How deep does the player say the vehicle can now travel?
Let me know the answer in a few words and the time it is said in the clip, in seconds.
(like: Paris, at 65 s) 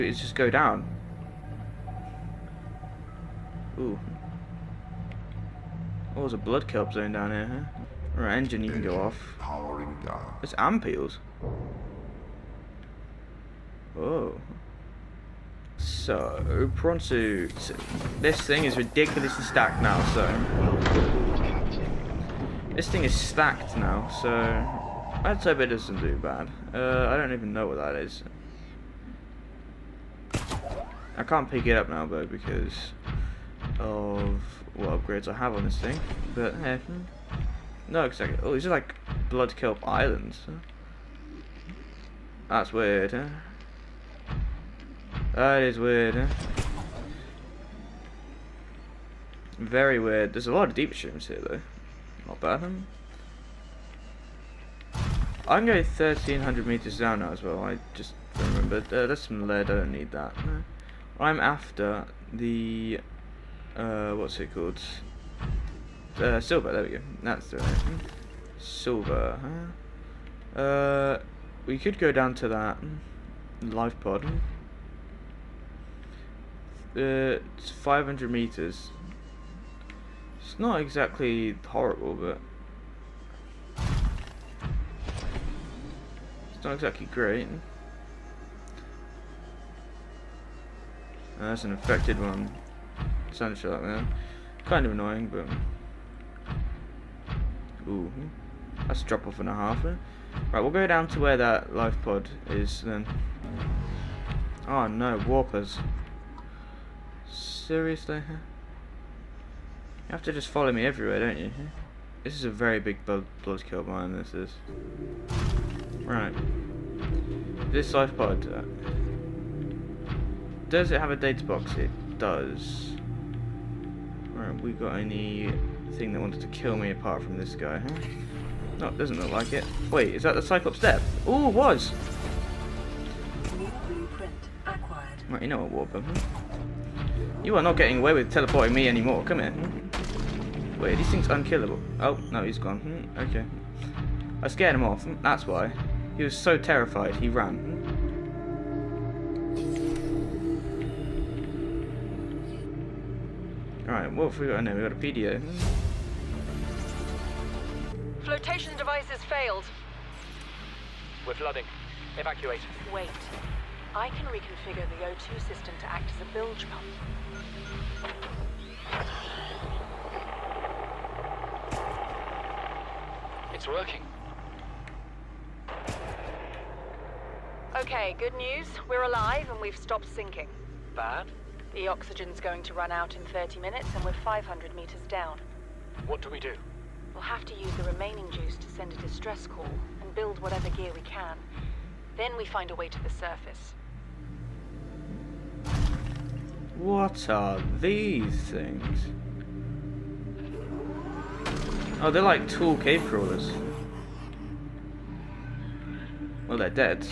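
1,300 meters, at 55 s.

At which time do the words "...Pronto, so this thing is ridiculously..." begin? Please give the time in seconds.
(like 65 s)
16 s.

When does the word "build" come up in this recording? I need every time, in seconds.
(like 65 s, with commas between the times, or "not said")
190 s.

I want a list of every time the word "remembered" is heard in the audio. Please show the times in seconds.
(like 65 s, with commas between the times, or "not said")
58 s.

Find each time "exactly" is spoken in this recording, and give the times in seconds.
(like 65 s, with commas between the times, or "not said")
38 s, 80 s, 86 s.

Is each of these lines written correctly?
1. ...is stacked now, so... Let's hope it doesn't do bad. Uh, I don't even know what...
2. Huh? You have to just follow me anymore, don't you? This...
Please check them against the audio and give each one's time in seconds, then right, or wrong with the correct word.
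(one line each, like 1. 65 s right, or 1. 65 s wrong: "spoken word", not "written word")
1. 23 s right
2. 108 s wrong: "everywhere", not "anymore".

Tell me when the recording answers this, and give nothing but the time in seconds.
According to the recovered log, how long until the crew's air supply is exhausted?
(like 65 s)
183 s.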